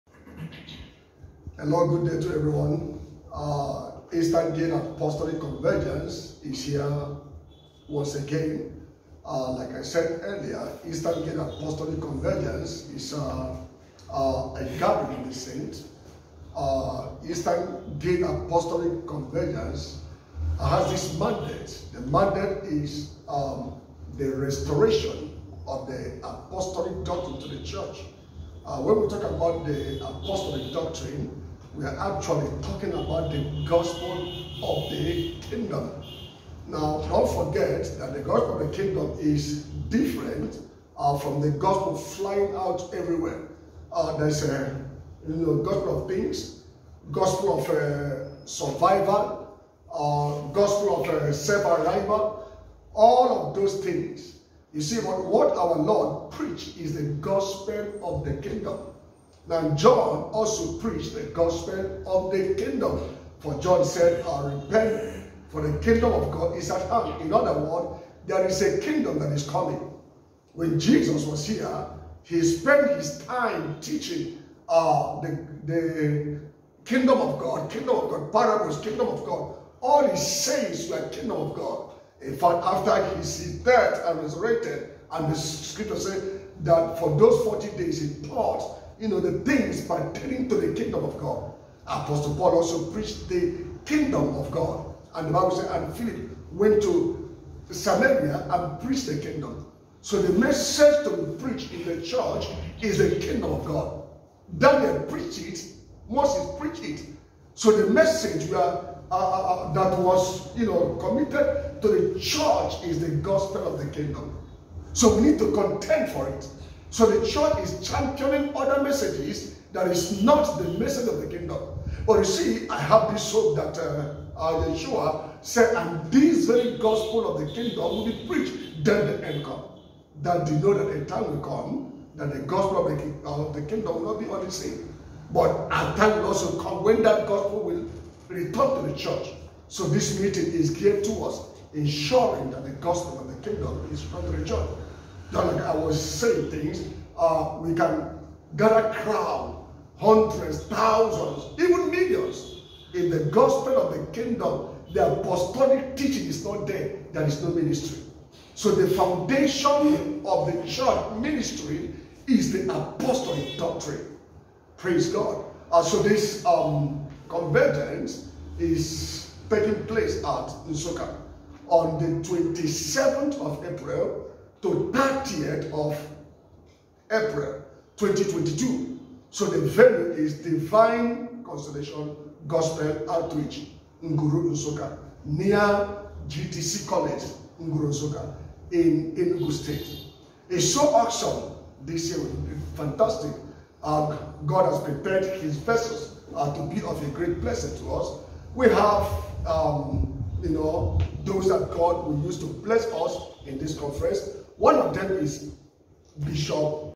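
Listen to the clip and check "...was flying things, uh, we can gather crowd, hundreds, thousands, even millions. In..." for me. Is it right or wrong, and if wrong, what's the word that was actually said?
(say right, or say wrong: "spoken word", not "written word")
wrong: "saying", not "flying".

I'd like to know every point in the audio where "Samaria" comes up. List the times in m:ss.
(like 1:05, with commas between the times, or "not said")
1:37.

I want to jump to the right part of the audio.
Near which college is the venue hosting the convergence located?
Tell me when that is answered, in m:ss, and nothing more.
3:06.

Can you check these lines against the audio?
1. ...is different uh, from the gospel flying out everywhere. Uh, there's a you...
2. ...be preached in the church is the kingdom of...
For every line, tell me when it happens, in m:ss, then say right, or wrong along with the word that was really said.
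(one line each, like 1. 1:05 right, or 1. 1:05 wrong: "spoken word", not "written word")
1. 0:39 right
2. 1:41 right.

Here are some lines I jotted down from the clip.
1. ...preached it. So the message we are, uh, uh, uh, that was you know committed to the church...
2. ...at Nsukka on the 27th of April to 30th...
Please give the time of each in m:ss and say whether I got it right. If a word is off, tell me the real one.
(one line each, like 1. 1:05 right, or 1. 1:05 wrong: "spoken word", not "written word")
1. 1:46 right
2. 2:50 right.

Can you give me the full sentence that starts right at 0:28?
Uh, when we talk about the apostolic doctrine, we are actually talking about the gospel of the kingdom.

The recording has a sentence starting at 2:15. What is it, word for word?
But a time will also come when that gospel will return to the church.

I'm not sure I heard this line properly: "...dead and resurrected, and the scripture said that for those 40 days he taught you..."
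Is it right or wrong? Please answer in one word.
right.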